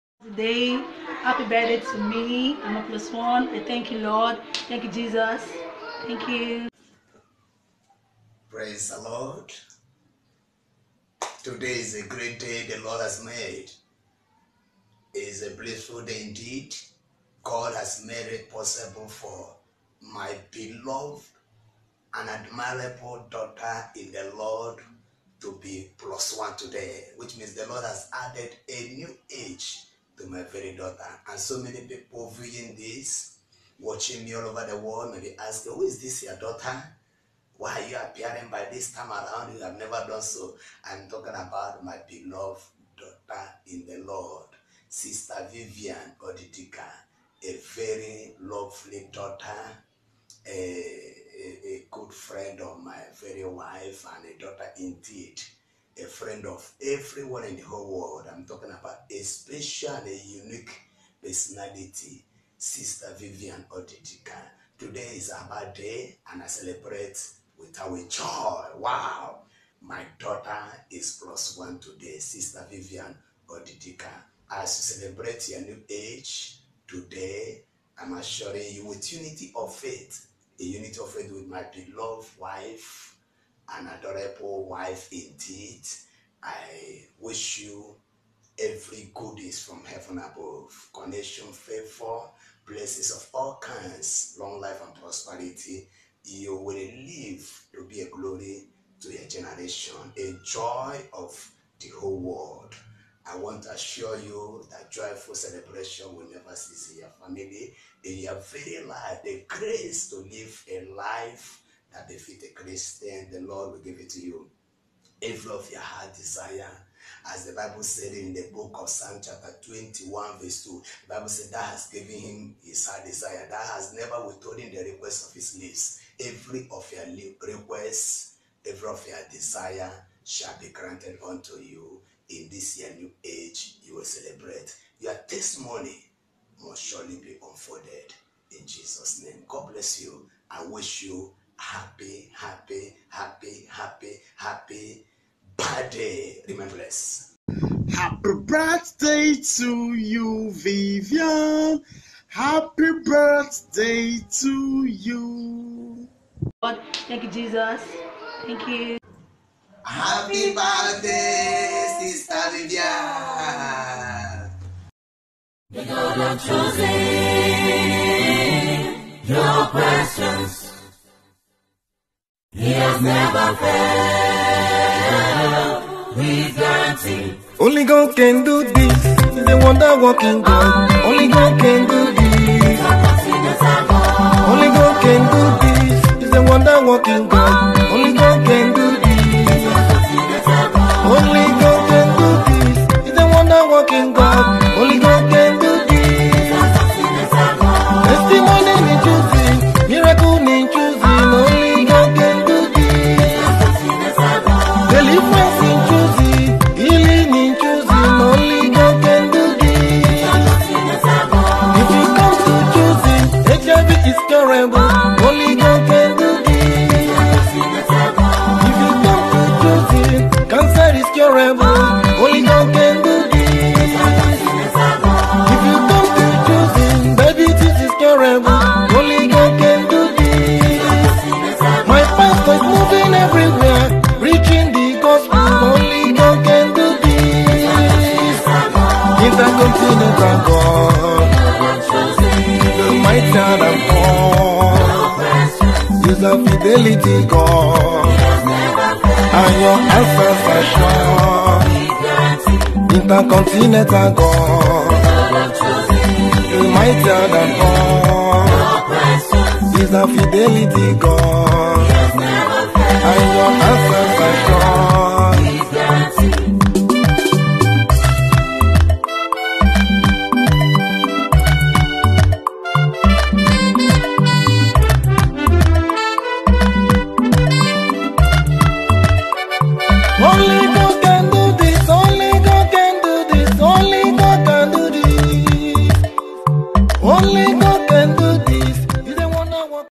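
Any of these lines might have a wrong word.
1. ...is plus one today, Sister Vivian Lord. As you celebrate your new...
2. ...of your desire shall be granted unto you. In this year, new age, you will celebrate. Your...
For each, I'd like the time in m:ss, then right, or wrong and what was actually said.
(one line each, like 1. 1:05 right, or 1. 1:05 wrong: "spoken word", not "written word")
1. 1:10 wrong: "Odidika", not "Lord"
2. 2:08 right.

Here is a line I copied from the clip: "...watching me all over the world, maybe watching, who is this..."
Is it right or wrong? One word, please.
wrong.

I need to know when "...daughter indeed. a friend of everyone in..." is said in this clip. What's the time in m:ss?
0:54.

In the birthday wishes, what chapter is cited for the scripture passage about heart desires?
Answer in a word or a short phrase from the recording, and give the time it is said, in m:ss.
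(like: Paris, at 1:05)
21, at 1:59.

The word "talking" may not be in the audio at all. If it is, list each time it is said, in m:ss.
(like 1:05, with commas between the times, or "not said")
0:41, 0:58.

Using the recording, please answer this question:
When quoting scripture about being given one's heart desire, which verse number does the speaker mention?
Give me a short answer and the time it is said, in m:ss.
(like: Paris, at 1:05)
2, at 2:00.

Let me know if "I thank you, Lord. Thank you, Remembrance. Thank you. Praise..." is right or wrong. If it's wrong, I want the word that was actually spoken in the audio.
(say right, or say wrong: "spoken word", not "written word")
wrong: "Jesus", not "Remembrance".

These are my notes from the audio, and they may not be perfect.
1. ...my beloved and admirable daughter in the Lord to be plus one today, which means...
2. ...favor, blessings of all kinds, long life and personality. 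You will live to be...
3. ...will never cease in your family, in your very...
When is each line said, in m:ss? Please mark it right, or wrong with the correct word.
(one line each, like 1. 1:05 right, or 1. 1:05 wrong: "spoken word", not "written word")
1. 0:20 right
2. 1:31 wrong: "prosperity", not "personality"
3. 1:46 right.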